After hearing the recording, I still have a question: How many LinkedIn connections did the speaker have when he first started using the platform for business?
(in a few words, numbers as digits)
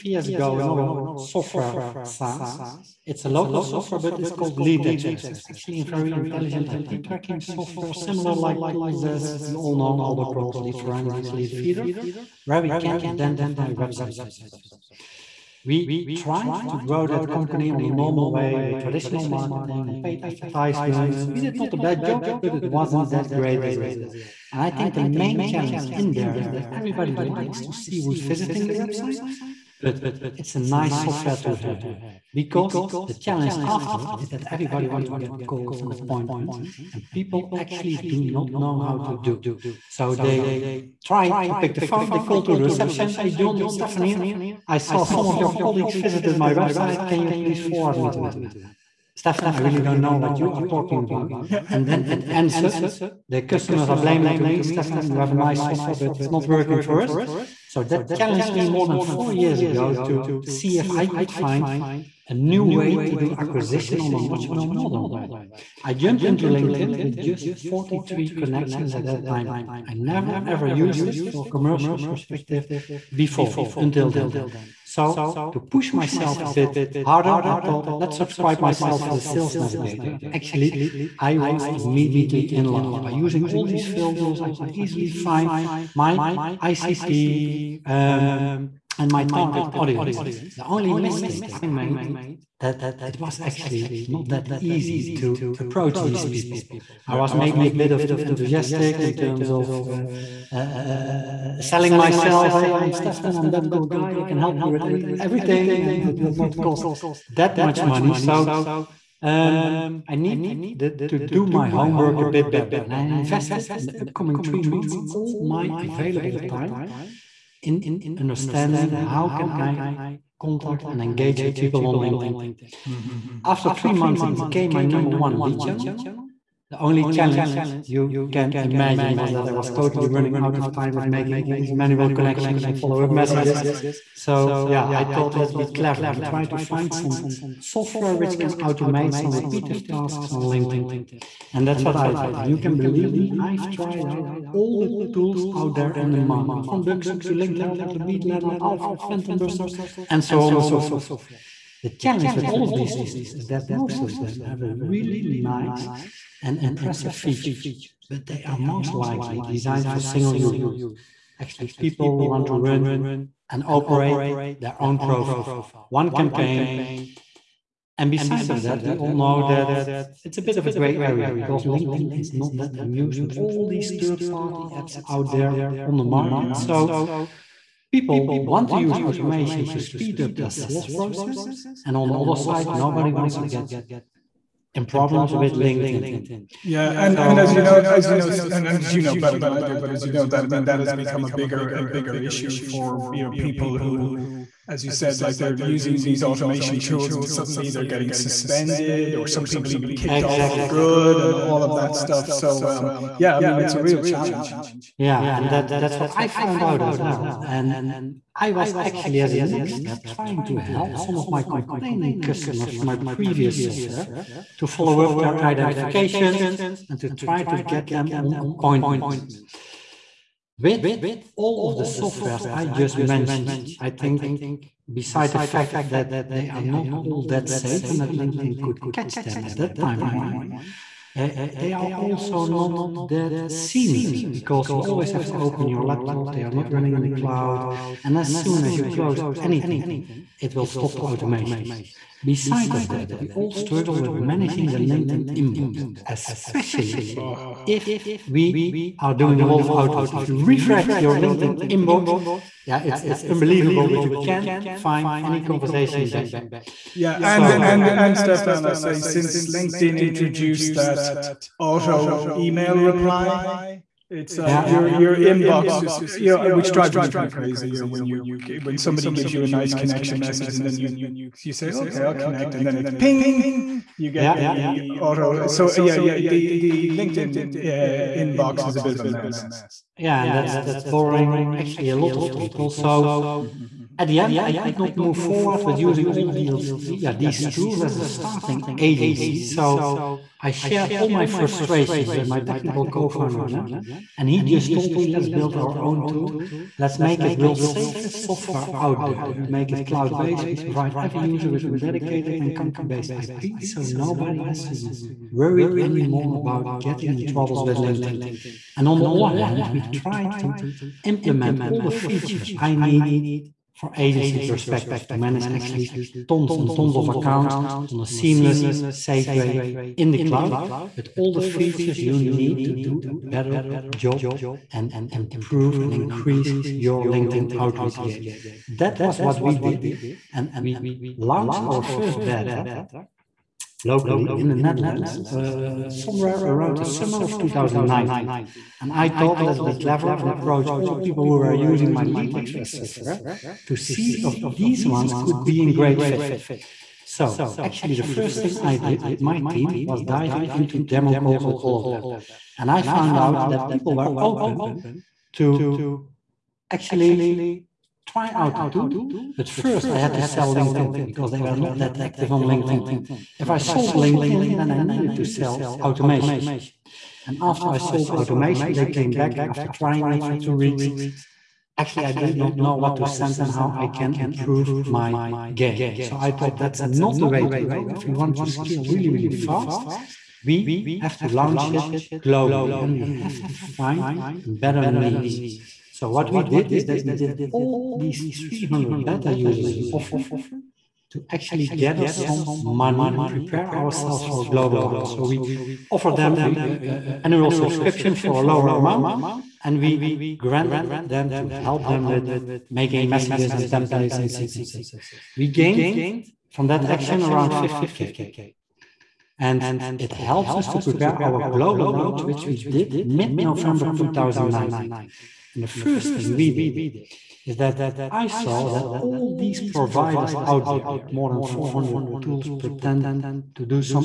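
43.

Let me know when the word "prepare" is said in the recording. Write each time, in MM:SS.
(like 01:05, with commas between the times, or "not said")
06:33, 06:50.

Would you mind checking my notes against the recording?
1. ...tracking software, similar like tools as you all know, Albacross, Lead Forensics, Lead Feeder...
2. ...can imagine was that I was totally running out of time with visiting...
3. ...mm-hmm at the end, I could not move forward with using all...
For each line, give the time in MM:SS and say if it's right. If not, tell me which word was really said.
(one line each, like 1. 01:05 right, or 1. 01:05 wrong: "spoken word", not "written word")
1. 00:07 right
2. 02:08 wrong: "making", not "visiting"
3. 04:43 right.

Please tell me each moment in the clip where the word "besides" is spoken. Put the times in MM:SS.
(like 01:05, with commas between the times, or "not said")
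02:48, 03:44, 04:02.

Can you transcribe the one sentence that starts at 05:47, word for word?
So actually, the first thing I did with my team was diving into demo calls with all of them.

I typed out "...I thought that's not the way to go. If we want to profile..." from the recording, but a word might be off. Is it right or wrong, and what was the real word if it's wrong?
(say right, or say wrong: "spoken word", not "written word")
wrong: "scale", not "profile".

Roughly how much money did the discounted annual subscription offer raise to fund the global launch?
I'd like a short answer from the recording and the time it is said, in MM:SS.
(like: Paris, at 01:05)
50K, at 06:47.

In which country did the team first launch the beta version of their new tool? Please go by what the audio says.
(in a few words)
the Netherlands.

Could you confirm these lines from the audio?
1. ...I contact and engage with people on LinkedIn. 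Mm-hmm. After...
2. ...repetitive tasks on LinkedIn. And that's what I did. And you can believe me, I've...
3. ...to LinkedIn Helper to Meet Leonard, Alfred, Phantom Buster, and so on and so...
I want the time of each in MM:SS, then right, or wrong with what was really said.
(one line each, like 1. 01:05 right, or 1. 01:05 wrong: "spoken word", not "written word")
1. 01:59 right
2. 02:19 right
3. 02:27 right.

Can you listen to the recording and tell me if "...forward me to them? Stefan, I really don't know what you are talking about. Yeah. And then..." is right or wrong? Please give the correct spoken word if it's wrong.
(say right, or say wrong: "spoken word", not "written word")
right.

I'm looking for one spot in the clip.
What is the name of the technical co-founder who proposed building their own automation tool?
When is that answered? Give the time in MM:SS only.
04:53.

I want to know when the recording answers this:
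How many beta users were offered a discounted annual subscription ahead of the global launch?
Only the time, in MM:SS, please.
06:28.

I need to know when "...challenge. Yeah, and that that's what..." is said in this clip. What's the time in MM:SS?
03:24.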